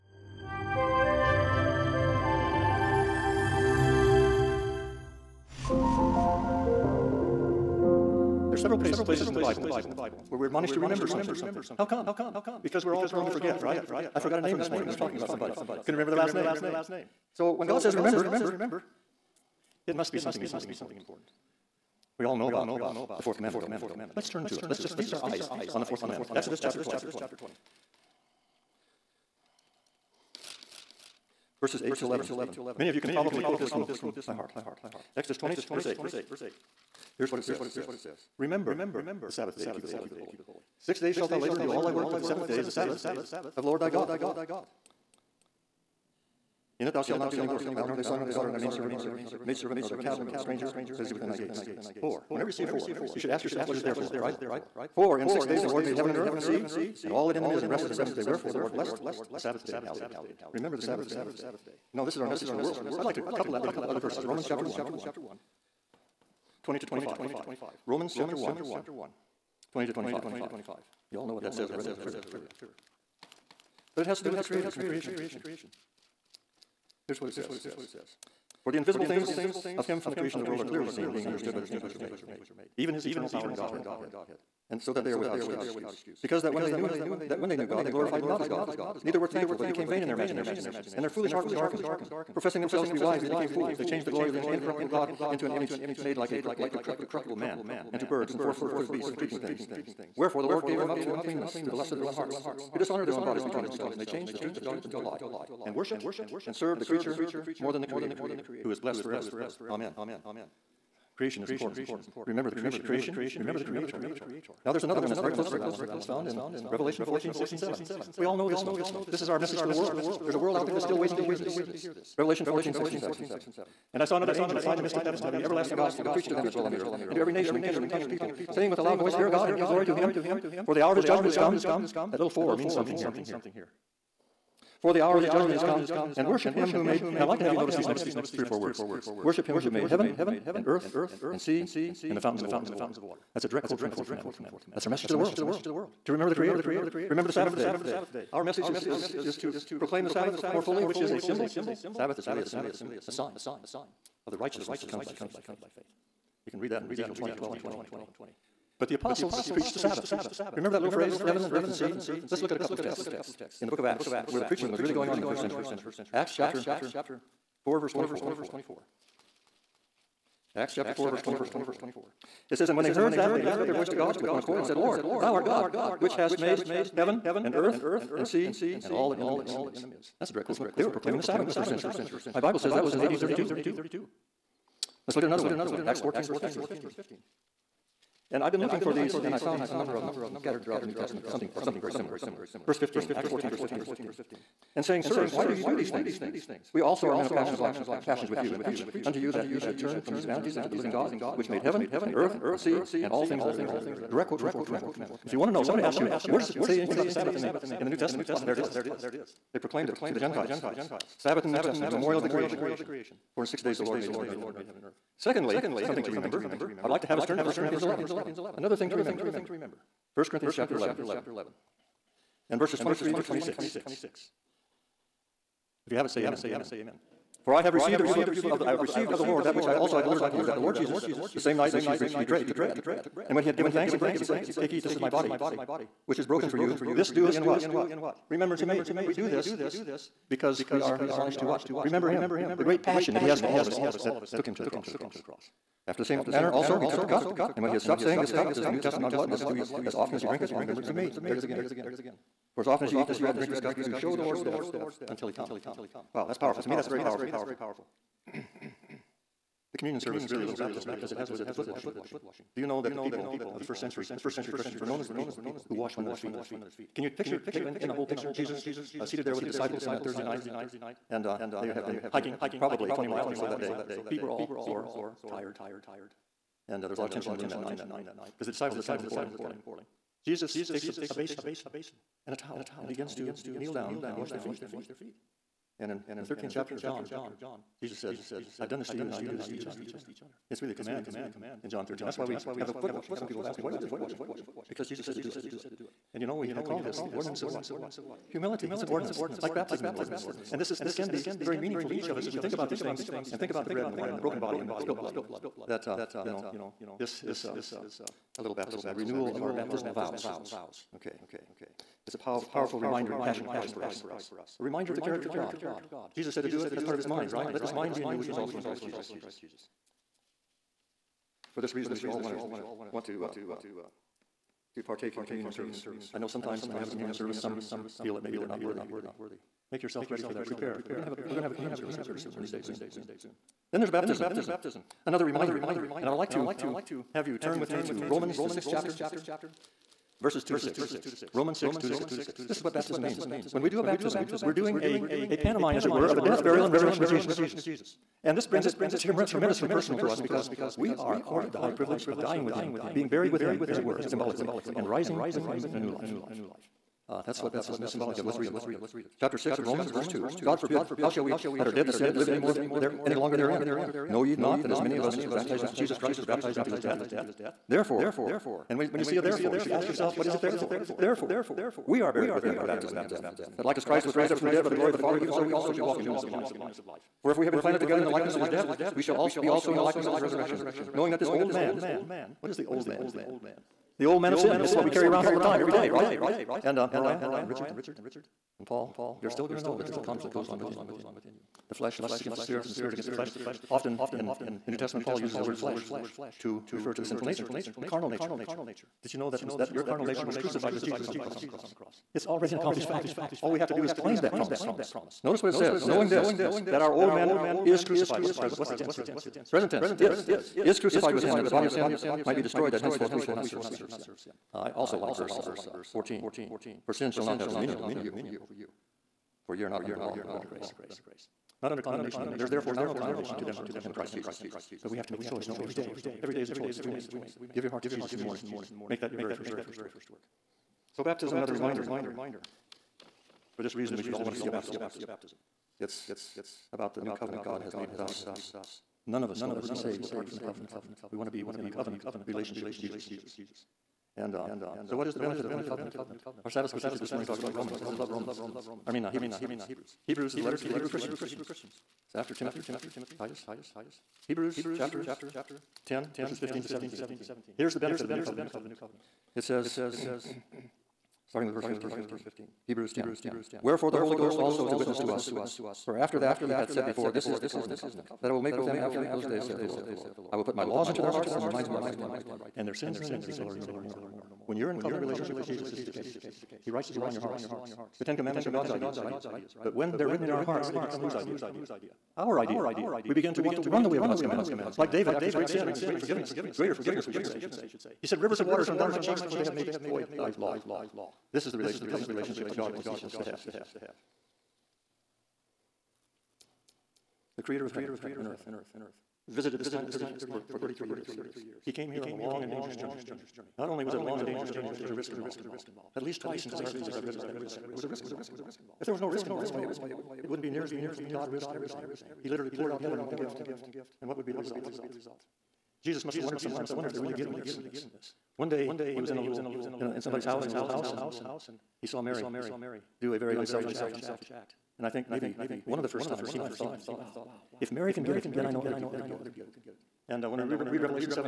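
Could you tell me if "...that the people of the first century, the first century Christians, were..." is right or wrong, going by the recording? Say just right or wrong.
right.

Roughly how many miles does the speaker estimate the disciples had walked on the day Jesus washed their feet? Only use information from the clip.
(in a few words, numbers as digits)
20 miles.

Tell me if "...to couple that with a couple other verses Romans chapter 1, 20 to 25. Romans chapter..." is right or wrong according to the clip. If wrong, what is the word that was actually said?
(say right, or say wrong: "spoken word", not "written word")
right.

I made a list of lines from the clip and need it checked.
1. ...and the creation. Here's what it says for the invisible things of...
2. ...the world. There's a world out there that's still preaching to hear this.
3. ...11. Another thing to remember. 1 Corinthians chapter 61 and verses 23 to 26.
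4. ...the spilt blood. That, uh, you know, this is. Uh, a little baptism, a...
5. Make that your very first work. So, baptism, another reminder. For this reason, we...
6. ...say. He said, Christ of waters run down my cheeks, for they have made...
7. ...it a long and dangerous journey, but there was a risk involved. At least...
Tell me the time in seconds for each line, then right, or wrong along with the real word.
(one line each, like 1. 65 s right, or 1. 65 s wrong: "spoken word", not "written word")
1. 74 s right
2. 119 s wrong: "waiting", not "preaching"
3. 217 s wrong: "11", not "61"
4. 304 s right
5. 428 s right
6. 487 s wrong: "Rivers", not "Christ"
7. 503 s right.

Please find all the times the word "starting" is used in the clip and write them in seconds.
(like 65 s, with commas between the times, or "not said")
461 s.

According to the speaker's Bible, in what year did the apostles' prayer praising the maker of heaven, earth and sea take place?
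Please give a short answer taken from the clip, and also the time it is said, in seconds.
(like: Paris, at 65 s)
AD 32, at 183 s.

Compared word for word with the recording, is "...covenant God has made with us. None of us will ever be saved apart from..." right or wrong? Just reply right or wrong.
right.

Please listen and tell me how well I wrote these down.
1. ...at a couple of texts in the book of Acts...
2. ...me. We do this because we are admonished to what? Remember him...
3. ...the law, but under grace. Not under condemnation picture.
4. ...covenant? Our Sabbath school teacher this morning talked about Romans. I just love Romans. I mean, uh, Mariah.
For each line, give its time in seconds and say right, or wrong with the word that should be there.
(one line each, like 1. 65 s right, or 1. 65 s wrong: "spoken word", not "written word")
1. 162 s right
2. 238 s right
3. 419 s wrong: "anymore", not "picture"
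4. 445 s wrong: "Hebrews", not "Mariah".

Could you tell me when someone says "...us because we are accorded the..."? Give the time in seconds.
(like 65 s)
350 s.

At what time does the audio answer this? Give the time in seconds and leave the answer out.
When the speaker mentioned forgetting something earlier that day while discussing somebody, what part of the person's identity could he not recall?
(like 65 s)
16 s.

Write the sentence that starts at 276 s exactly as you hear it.
And uh, there was a lot of tension in the room that night because the disciples had kind of been quarreling.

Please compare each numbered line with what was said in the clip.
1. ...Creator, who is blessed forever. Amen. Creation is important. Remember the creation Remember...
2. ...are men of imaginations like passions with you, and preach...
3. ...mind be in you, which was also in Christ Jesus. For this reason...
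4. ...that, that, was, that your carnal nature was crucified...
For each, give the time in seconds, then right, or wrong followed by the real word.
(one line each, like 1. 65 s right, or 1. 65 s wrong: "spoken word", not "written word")
1. 107 s right
2. 197 s wrong: "passions", not "imaginations"
3. 317 s right
4. 399 s right.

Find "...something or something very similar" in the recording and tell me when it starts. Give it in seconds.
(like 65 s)
191 s.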